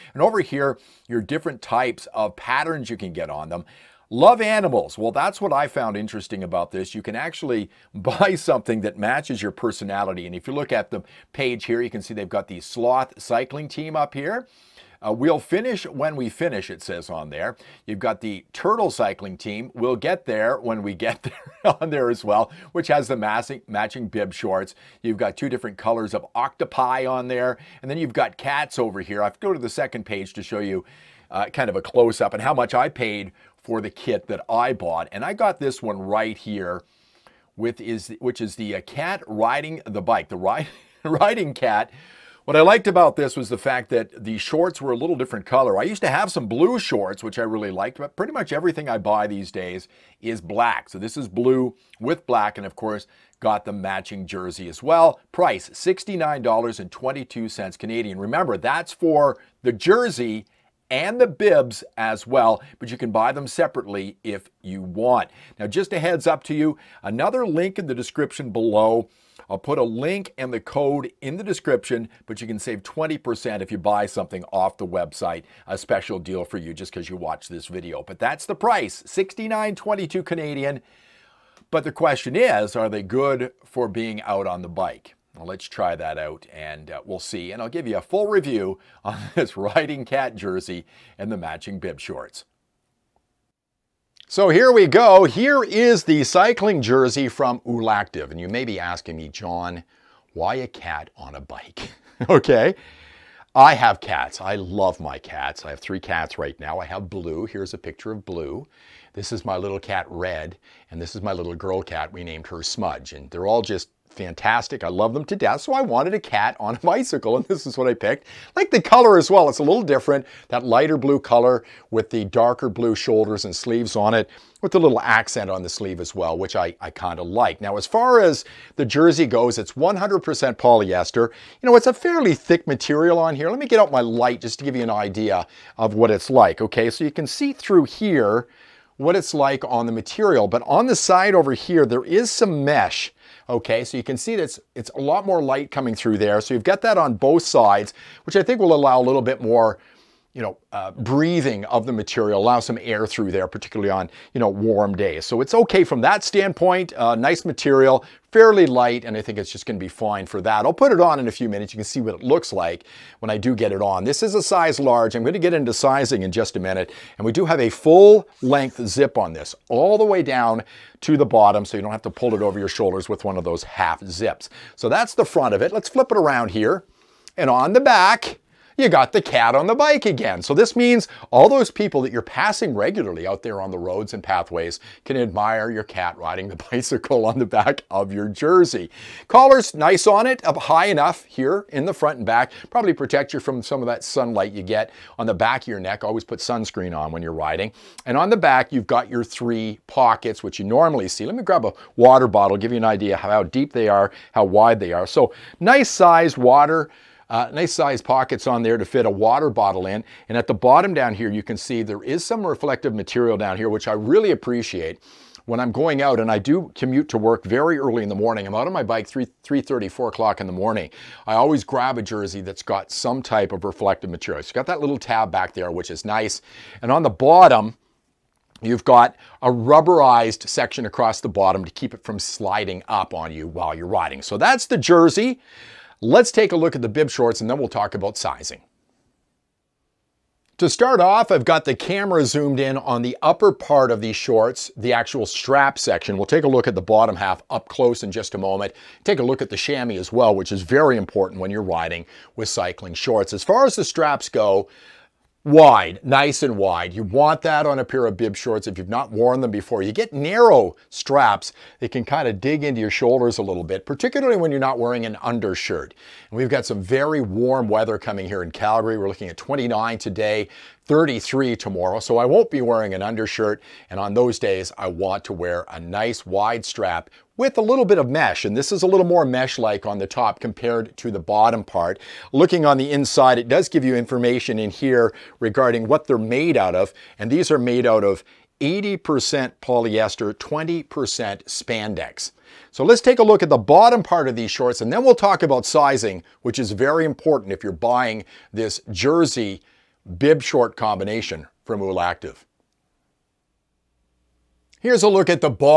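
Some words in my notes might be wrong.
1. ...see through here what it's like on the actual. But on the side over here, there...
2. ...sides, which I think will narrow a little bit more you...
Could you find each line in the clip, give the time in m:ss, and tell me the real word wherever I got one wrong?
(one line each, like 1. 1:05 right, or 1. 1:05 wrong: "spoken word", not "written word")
1. 2:17 wrong: "material", not "actual"
2. 2:27 wrong: "allow", not "narrow".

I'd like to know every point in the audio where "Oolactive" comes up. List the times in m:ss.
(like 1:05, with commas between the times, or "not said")
1:37, 5:01.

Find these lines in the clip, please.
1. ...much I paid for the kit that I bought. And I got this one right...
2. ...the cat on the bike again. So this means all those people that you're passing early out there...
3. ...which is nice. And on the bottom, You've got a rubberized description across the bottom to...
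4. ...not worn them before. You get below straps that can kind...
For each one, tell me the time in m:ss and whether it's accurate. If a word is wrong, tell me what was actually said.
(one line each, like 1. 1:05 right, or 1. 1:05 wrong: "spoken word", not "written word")
1. 0:32 right
2. 2:59 wrong: "regularly", not "early"
3. 3:45 wrong: "section", not "description"
4. 4:18 wrong: "narrow", not "below".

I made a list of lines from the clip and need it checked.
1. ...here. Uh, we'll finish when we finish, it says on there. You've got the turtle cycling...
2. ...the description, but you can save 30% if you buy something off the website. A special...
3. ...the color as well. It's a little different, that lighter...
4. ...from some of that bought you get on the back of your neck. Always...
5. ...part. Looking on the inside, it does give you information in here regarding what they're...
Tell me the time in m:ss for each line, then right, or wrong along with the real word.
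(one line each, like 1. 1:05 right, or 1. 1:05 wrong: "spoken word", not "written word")
1. 0:14 right
2. 1:11 wrong: "20", not "30"
3. 1:58 right
4. 3:13 wrong: "sunlight", not "bought"
5. 4:41 right.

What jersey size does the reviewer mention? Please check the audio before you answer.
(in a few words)
Large.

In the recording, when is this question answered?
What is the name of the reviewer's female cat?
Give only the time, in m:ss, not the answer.
1:52.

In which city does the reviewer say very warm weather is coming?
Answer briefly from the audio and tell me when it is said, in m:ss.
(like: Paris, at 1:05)
Calgary, at 4:28.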